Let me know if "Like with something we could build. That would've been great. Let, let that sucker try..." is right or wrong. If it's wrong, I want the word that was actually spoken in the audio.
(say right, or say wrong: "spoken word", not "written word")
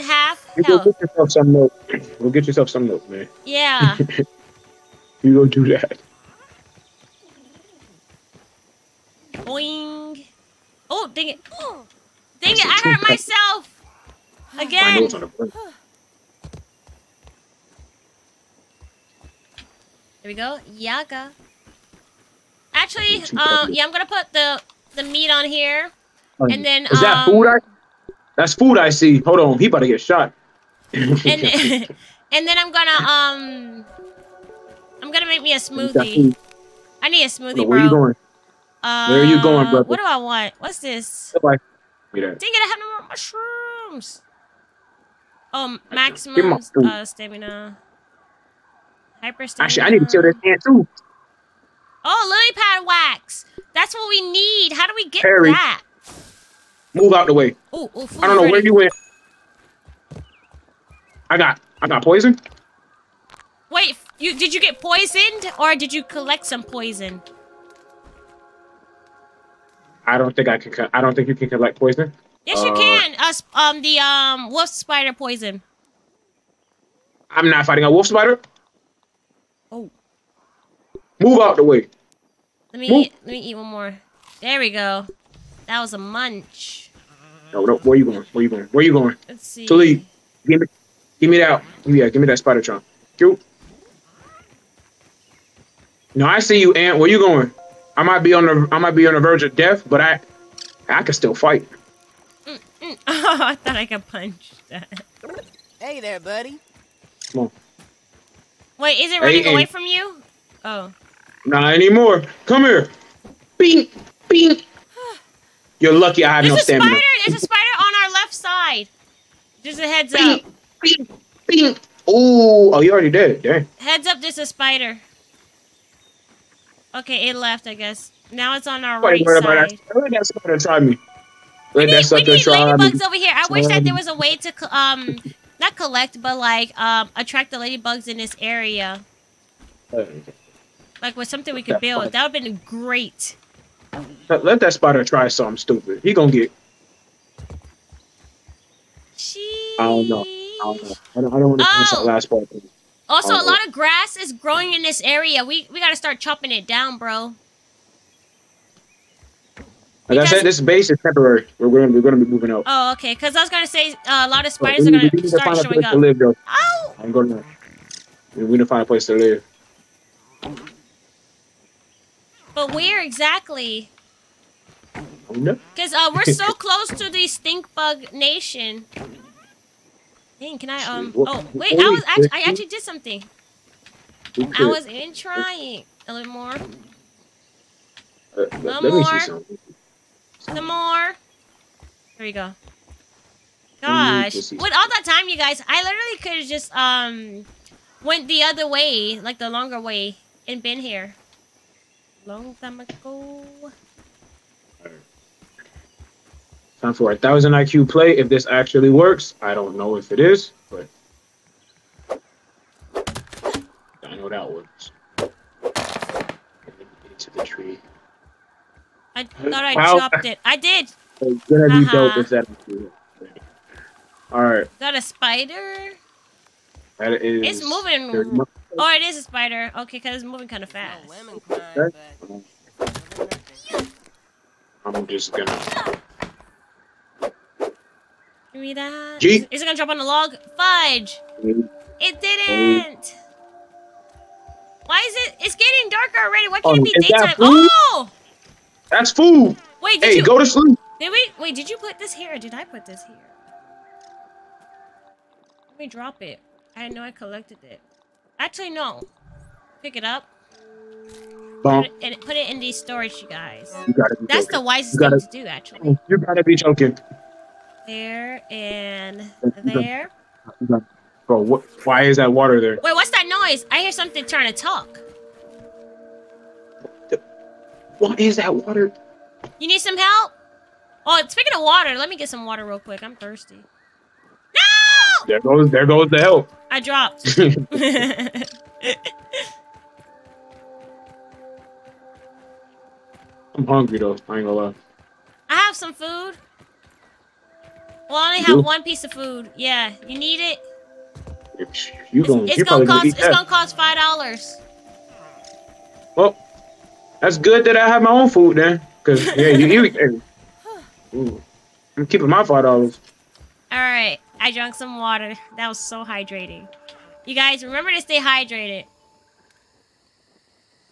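wrong: "spider", not "sucker".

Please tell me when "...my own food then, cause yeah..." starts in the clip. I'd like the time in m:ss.
5:08.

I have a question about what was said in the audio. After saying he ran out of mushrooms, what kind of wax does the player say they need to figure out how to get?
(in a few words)
lily pad wax.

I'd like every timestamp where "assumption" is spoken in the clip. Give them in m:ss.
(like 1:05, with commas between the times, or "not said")
not said.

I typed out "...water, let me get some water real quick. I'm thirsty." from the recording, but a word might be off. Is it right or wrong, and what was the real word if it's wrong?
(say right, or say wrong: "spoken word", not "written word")
right.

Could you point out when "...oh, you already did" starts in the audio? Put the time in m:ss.
2:02.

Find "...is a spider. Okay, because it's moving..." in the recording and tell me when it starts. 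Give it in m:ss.
3:49.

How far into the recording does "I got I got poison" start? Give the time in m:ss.
1:01.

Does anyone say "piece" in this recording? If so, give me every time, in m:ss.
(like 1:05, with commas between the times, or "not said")
4:58.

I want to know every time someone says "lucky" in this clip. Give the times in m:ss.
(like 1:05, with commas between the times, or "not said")
1:55.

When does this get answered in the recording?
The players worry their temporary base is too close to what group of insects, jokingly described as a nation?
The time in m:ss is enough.
2:57.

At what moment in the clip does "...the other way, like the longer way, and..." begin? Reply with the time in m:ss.
3:18.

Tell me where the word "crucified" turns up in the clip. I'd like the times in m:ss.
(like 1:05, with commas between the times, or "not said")
not said.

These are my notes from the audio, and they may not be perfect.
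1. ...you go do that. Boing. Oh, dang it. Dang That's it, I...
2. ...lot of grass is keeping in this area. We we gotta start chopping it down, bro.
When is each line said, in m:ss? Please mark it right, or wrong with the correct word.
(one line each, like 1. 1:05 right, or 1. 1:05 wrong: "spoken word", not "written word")
1. 0:05 right
2. 2:33 wrong: "growing", not "keeping".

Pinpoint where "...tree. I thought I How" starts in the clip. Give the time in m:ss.
3:37.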